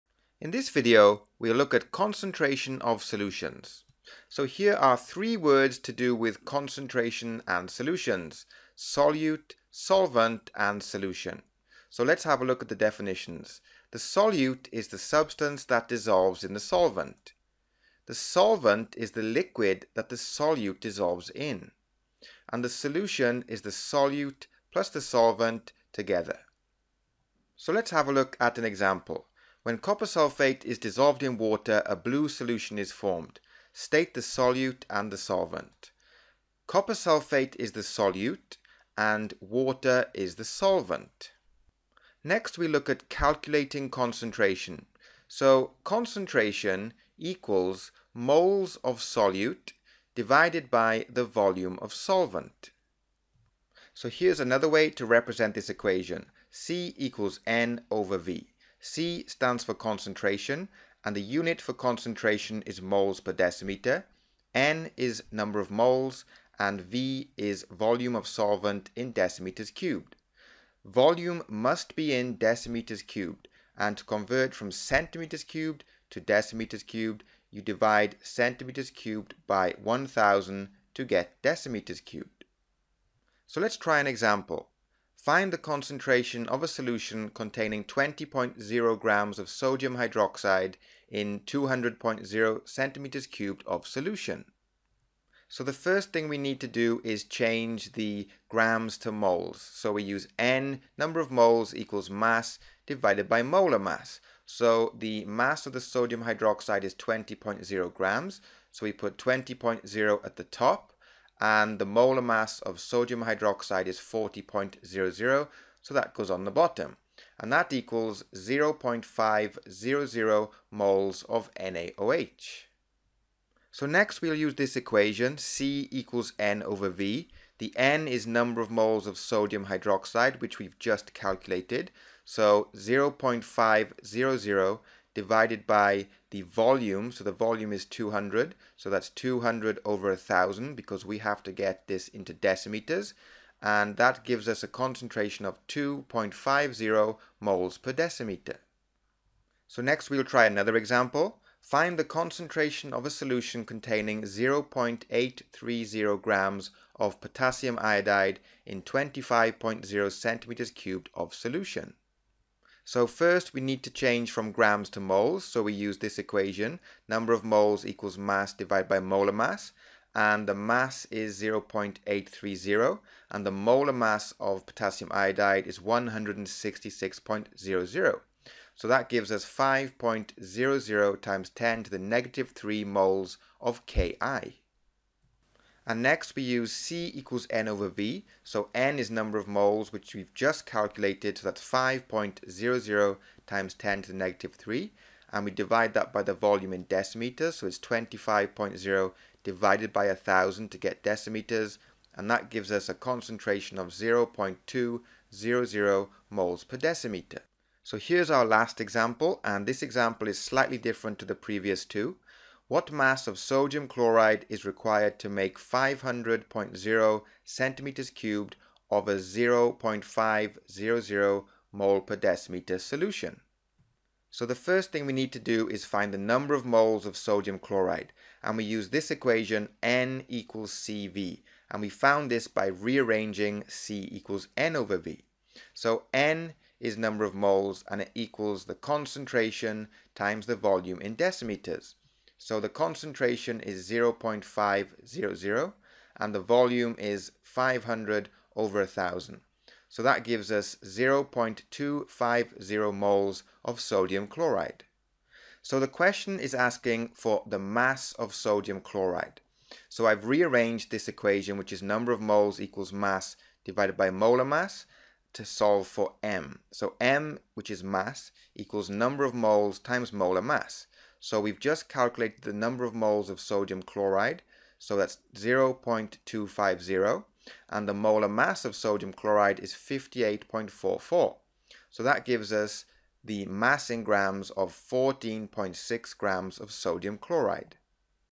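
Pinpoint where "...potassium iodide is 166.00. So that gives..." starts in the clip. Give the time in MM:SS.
02:54.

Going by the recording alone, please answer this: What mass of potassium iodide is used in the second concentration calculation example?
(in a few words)
0.830 grams.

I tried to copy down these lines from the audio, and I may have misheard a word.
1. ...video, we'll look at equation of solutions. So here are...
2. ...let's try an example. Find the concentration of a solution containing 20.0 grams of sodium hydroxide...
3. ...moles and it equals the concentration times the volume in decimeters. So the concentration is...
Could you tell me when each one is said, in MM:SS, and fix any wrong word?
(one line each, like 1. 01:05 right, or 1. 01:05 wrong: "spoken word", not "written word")
1. 00:00 wrong: "concentration", not "equation"
2. 01:23 right
3. 03:57 right.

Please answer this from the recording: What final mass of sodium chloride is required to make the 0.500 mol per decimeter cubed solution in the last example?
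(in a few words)
14.6 grams.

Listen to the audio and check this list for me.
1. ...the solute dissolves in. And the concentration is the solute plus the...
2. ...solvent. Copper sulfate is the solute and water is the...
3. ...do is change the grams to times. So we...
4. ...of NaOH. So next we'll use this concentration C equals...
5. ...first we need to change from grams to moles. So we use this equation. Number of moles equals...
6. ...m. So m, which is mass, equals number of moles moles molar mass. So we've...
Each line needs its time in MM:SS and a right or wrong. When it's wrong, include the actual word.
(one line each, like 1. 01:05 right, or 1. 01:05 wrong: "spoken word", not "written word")
1. 00:20 wrong: "solution", not "concentration"
2. 00:35 right
3. 01:36 wrong: "moles", not "times"
4. 02:01 wrong: "equation", not "concentration"
5. 02:43 right
6. 04:26 wrong: "times", not "moles".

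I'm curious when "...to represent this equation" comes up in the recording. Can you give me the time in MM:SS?
00:54.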